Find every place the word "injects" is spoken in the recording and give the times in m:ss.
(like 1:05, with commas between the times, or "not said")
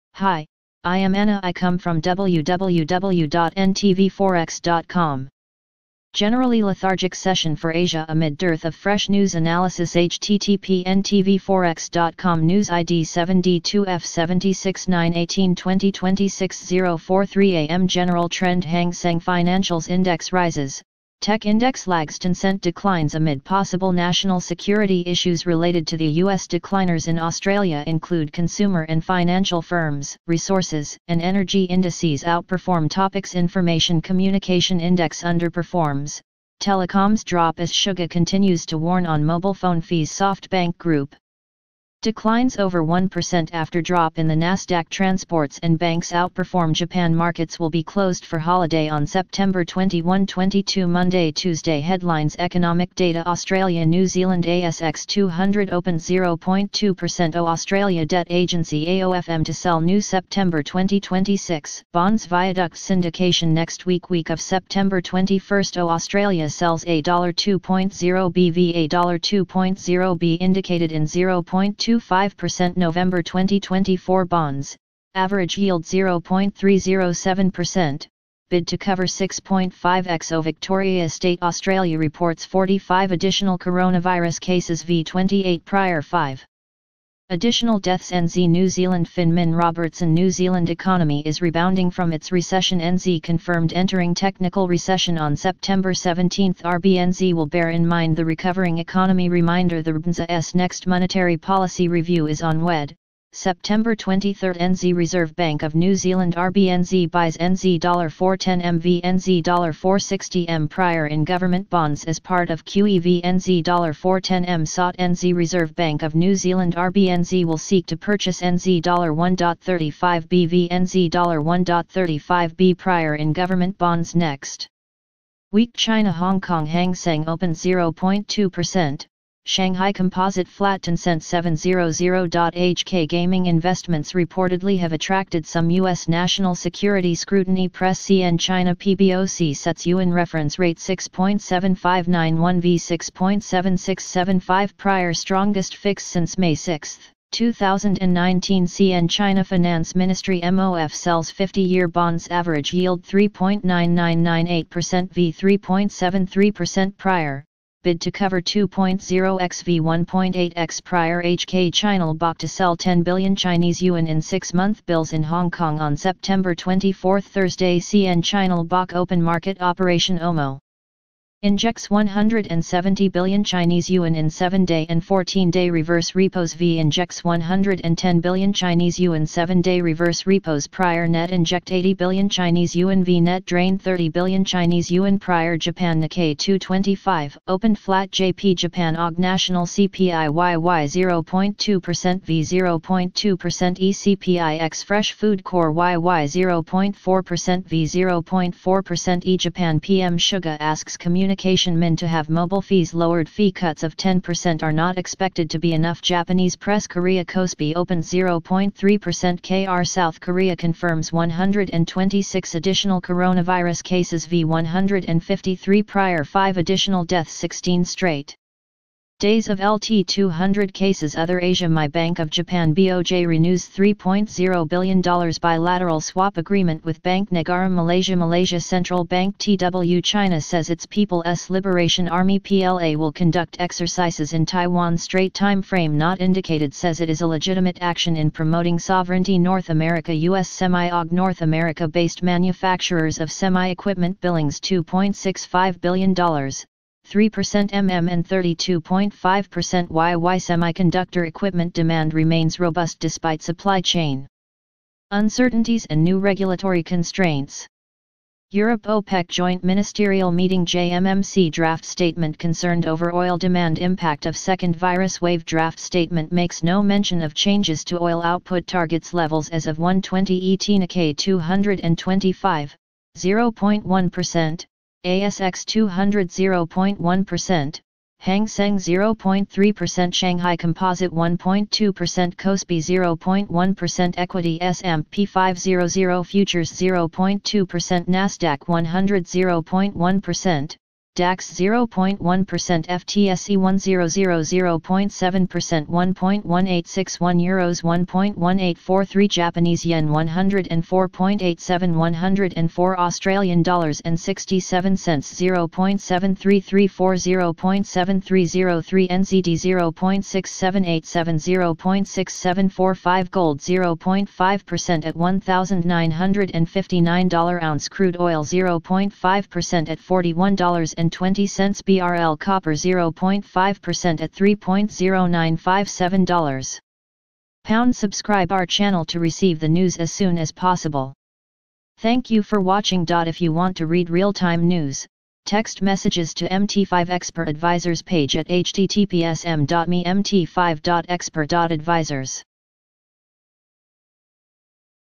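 2:51, 2:56, 3:01.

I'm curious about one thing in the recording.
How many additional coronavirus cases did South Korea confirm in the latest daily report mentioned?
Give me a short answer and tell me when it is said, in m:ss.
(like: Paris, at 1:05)
126, at 3:31.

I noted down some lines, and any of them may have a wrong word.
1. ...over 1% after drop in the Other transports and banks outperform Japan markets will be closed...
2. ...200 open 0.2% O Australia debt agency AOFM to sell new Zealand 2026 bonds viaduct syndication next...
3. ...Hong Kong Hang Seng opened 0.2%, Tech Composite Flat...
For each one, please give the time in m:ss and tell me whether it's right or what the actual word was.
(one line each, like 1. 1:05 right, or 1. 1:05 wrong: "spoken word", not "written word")
1. 0:42 wrong: "Nasdaq", not "Other"
2. 0:55 wrong: "September", not "Zealand"
3. 2:06 wrong: "Shanghai", not "Tech".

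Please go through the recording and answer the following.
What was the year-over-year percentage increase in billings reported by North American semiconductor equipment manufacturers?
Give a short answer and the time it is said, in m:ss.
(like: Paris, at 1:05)
32.5%, at 4:08.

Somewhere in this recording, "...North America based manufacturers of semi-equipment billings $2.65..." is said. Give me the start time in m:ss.
4:01.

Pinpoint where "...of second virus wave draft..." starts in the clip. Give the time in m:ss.
4:24.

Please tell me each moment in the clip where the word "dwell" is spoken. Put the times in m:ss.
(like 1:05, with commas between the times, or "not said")
not said.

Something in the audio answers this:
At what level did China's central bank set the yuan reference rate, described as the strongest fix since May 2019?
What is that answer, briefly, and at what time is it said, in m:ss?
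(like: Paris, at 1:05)
6.7591, at 2:20.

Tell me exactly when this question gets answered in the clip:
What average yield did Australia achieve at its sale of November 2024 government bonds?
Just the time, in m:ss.
1:15.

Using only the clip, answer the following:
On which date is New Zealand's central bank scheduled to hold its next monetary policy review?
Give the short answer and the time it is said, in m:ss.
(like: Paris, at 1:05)
September 23, at 1:43.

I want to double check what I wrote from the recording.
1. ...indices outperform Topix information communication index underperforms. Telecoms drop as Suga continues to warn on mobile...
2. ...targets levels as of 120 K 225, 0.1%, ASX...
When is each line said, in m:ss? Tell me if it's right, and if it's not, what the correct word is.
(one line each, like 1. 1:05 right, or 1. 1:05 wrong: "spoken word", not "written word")
1. 0:31 right
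2. 4:28 right.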